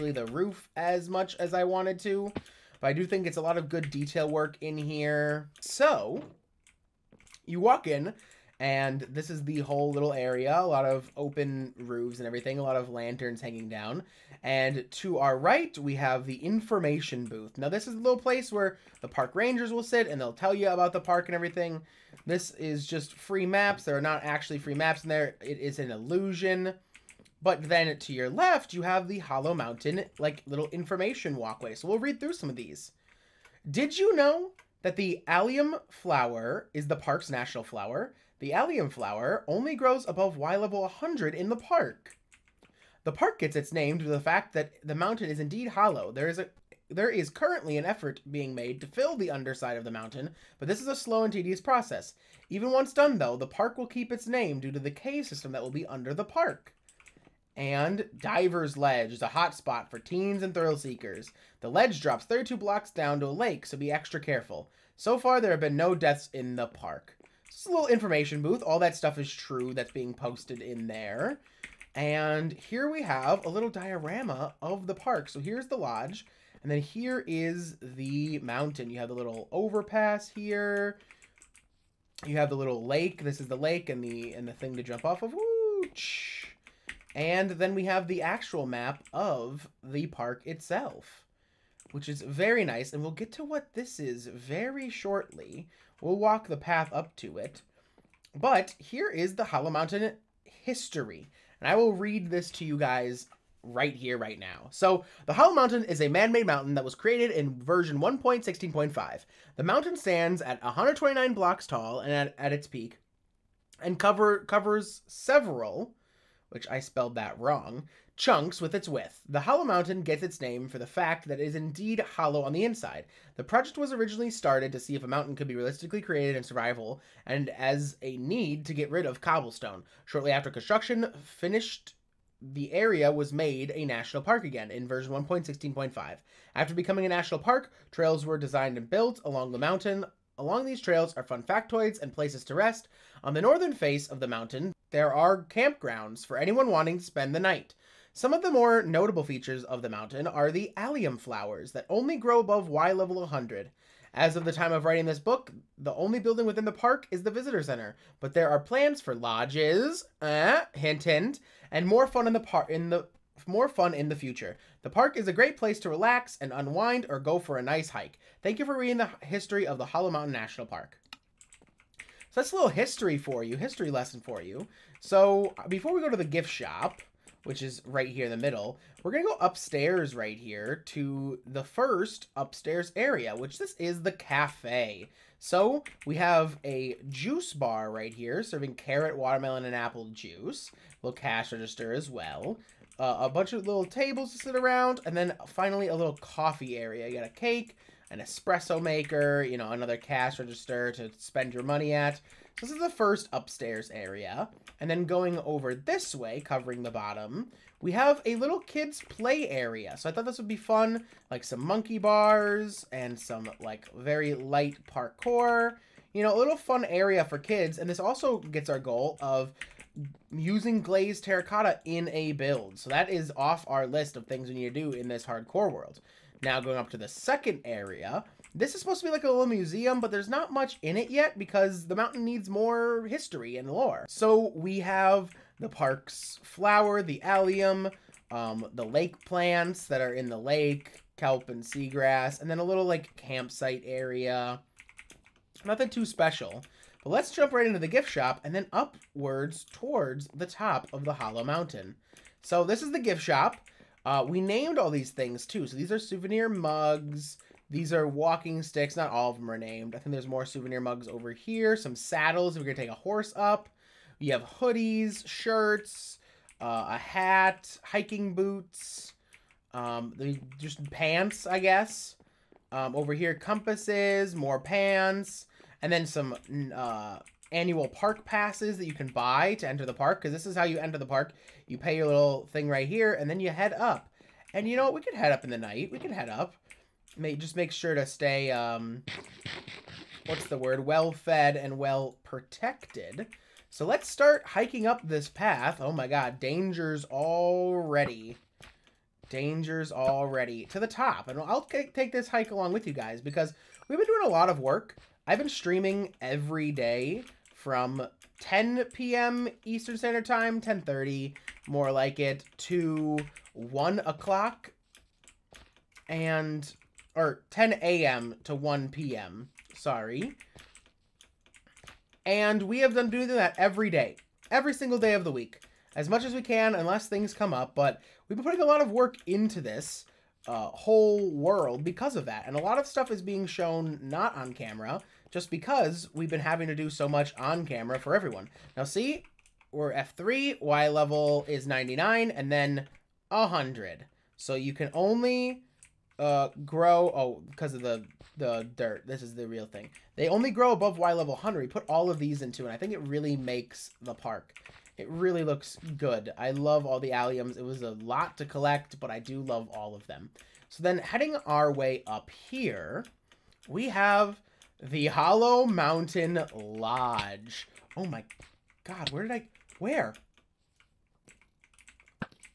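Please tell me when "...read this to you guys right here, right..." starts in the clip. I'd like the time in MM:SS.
01:41.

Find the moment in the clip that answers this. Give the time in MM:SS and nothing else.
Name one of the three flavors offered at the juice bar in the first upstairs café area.
03:08.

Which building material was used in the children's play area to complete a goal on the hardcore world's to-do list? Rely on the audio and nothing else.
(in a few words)
Glazed terracotta.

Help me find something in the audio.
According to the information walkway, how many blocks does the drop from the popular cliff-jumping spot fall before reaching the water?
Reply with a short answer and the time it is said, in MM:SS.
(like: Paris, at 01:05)
32, at 01:02.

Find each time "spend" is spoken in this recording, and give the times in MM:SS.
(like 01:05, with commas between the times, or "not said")
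02:27, 03:21.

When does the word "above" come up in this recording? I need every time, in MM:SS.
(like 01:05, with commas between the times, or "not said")
00:40, 02:32, 05:50.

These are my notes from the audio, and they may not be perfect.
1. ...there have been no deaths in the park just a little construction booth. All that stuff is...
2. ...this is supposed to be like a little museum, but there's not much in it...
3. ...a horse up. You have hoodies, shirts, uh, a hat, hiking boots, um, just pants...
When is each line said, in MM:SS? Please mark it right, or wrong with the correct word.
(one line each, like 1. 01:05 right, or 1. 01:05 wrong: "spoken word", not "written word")
1. 01:05 wrong: "information", not "construction"
2. 03:48 right
3. 04:22 right.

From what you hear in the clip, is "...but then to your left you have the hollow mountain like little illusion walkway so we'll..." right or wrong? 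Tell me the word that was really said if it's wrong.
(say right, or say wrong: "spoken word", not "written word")
wrong: "information", not "illusion".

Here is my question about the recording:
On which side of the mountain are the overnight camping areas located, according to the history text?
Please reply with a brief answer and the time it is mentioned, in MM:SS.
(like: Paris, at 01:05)
Northern face, at 02:23.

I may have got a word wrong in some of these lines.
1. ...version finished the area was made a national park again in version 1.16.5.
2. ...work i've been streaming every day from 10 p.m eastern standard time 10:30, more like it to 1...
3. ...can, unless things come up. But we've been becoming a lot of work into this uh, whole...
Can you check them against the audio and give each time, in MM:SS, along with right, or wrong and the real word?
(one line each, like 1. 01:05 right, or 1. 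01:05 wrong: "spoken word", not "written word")
1. 02:10 wrong: "construction", not "version"
2. 05:04 right
3. 05:26 wrong: "putting", not "becoming".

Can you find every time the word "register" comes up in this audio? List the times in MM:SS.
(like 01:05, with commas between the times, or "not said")
03:11, 03:20.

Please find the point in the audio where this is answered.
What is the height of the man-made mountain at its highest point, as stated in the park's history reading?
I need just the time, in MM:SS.
01:50.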